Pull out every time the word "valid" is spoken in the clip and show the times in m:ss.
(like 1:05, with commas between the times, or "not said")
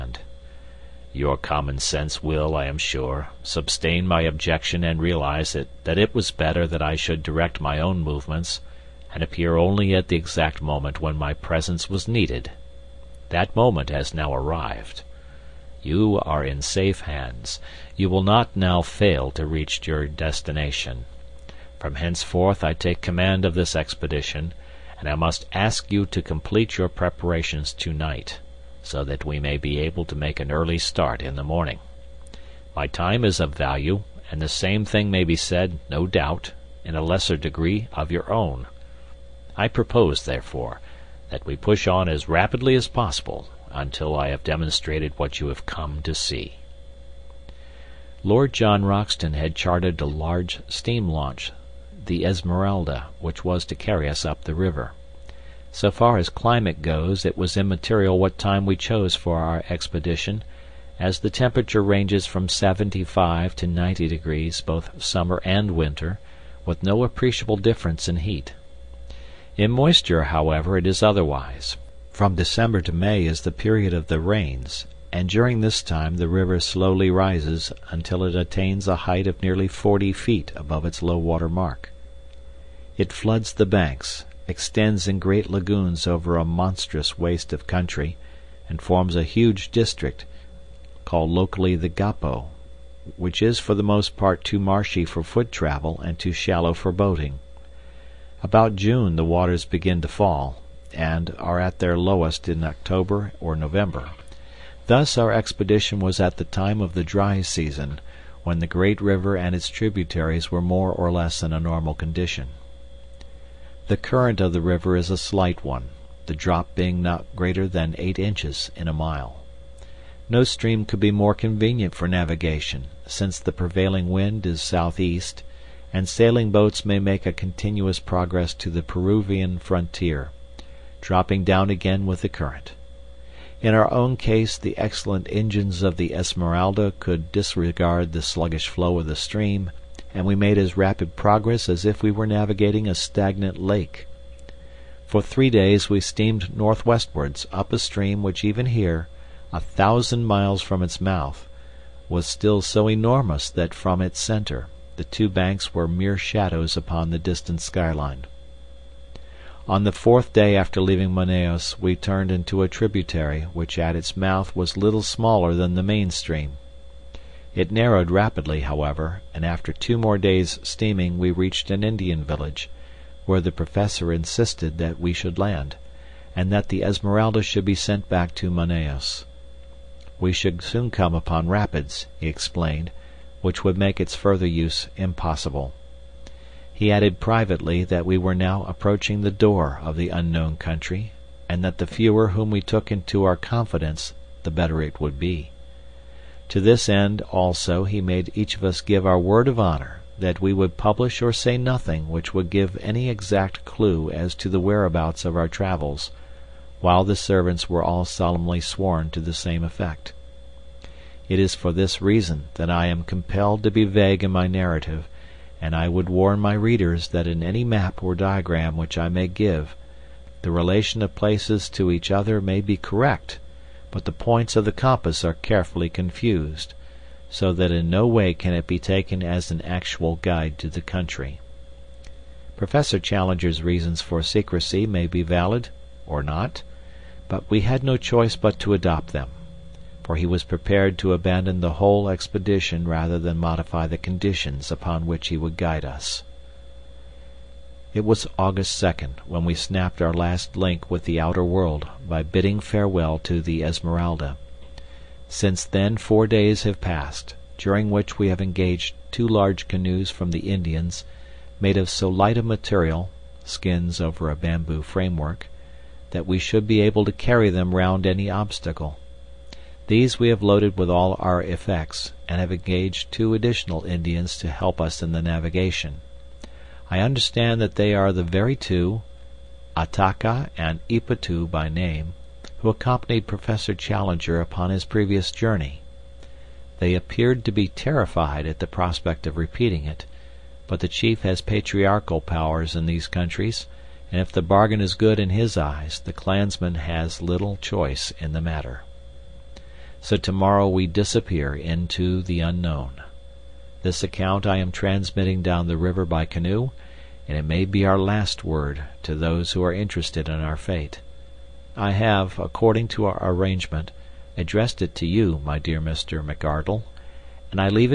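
3:55.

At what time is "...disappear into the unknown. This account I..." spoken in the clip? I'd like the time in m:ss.
5:00.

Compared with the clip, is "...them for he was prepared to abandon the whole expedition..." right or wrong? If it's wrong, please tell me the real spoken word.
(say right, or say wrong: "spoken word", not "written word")
right.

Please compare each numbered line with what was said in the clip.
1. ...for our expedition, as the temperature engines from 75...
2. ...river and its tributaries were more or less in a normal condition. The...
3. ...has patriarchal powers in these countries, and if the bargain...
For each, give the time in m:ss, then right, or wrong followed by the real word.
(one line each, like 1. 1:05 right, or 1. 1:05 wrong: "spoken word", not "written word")
1. 0:59 wrong: "ranges", not "engines"
2. 1:49 right
3. 4:51 right.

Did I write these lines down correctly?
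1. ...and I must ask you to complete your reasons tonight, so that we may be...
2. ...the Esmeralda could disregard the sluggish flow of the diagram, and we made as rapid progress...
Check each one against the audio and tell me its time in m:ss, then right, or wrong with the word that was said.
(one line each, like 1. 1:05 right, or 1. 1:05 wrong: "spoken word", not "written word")
1. 0:24 wrong: "preparations", not "reasons"
2. 2:15 wrong: "stream", not "diagram".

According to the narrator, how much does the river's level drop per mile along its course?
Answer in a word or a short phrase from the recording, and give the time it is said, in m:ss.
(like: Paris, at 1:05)
8 inches, at 1:57.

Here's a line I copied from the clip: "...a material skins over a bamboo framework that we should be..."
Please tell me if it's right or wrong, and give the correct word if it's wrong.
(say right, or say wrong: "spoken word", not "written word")
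right.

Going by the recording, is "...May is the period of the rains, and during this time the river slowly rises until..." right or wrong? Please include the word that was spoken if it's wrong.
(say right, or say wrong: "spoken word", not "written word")
right.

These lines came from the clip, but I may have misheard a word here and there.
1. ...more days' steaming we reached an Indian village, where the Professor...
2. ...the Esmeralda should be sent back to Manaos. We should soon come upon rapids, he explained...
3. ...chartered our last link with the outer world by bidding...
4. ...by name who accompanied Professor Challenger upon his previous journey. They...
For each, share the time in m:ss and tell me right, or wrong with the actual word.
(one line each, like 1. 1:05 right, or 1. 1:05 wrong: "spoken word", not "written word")
1. 2:49 right
2. 2:56 right
3. 4:09 wrong: "snapped", not "chartered"
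4. 4:41 right.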